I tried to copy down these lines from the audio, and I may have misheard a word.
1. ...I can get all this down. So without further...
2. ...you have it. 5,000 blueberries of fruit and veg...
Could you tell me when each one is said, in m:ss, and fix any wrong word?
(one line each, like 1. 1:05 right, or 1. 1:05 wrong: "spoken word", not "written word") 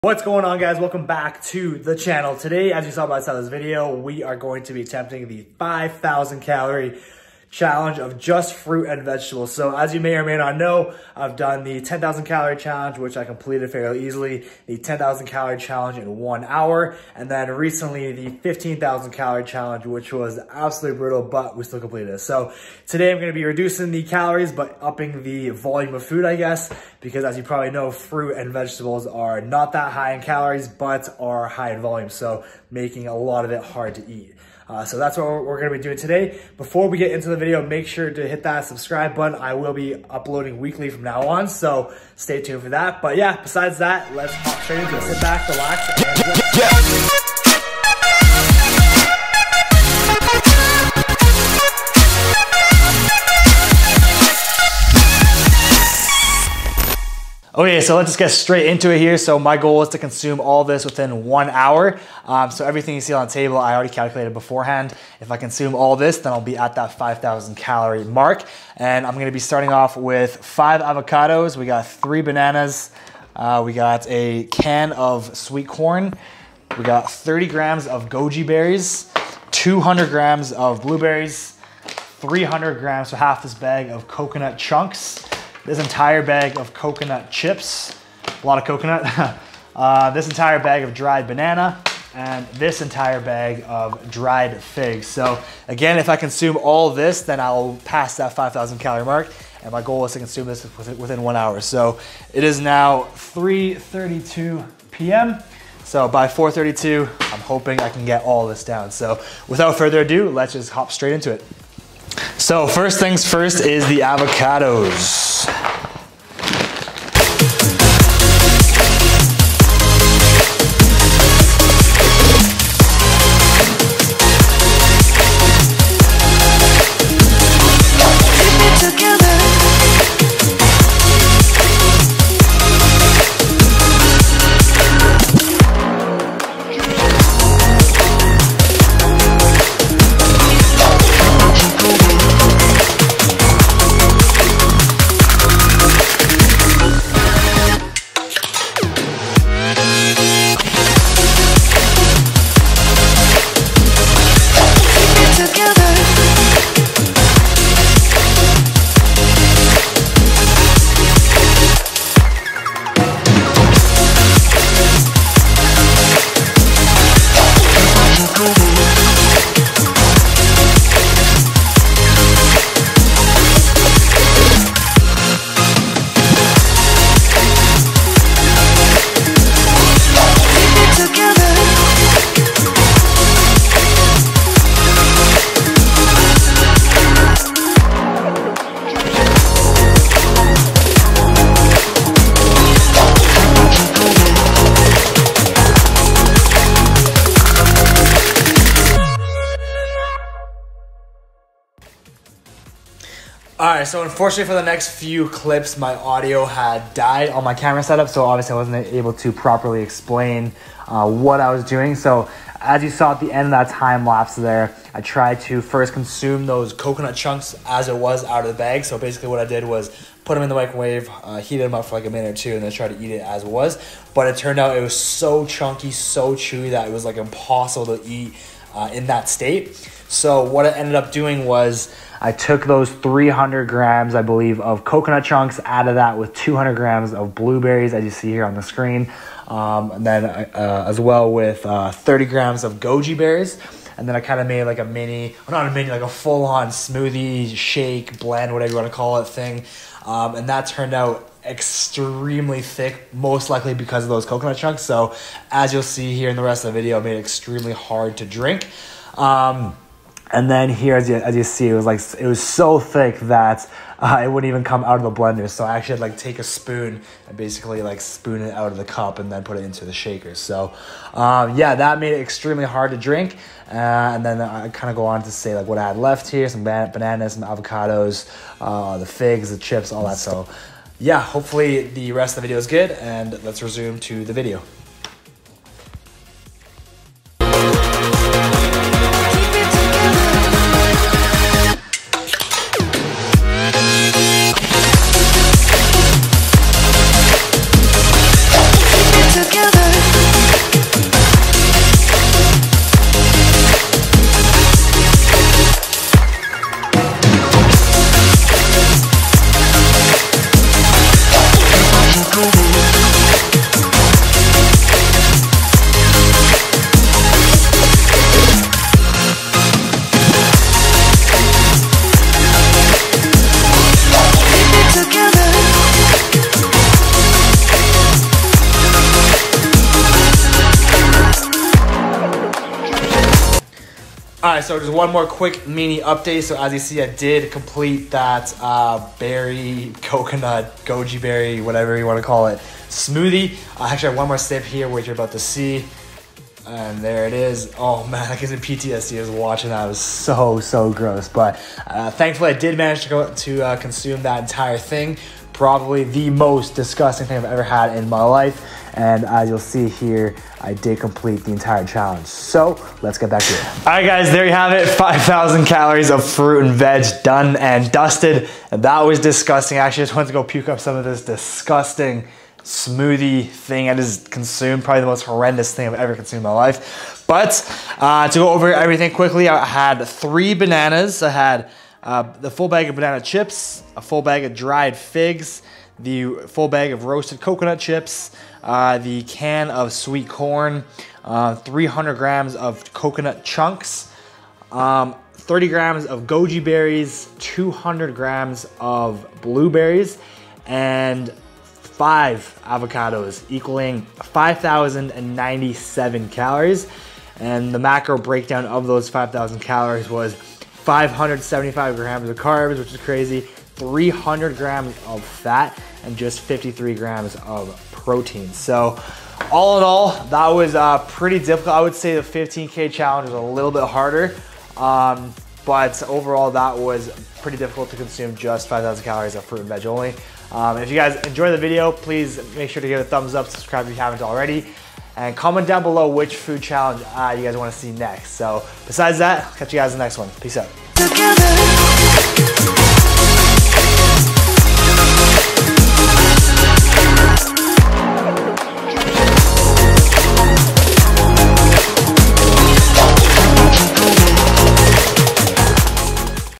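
1. 1:47 right
2. 6:04 wrong: "calories", not "blueberries".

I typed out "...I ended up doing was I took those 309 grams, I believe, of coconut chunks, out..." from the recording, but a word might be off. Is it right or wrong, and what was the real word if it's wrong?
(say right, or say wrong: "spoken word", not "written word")
wrong: "300", not "309".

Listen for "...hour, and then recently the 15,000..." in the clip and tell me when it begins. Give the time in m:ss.
0:16.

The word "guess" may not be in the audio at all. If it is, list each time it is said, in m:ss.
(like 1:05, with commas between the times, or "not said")
0:26, 5:48.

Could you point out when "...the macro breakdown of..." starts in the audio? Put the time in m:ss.
6:47.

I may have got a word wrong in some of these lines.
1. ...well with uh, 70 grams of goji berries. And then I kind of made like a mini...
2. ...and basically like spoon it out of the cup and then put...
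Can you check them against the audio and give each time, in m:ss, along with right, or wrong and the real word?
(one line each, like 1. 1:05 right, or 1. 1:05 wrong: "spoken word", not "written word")
1. 4:00 wrong: "30", not "70"
2. 4:27 right.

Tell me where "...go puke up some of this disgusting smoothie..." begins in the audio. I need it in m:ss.
6:10.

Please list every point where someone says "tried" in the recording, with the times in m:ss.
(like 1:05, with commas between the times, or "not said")
3:35, 3:42.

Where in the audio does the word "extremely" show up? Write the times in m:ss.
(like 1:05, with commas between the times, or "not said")
4:11, 4:17, 4:32.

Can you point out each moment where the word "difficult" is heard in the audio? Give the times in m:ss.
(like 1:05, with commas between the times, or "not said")
7:01, 7:07.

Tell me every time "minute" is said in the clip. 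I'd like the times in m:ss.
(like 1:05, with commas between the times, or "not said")
3:42.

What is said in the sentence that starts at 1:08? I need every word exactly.
And I'm gonna be starting off with five avocados.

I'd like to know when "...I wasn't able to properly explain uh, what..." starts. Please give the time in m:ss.
3:28.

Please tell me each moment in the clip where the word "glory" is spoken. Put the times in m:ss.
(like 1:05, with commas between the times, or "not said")
not said.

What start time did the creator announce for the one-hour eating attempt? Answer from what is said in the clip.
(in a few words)
3:32 p.m.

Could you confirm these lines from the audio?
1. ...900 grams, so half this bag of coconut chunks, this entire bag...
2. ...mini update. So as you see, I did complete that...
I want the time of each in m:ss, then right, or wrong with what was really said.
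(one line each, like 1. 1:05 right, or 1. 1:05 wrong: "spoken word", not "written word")
1. 1:22 wrong: "300", not "900"
2. 5:35 right.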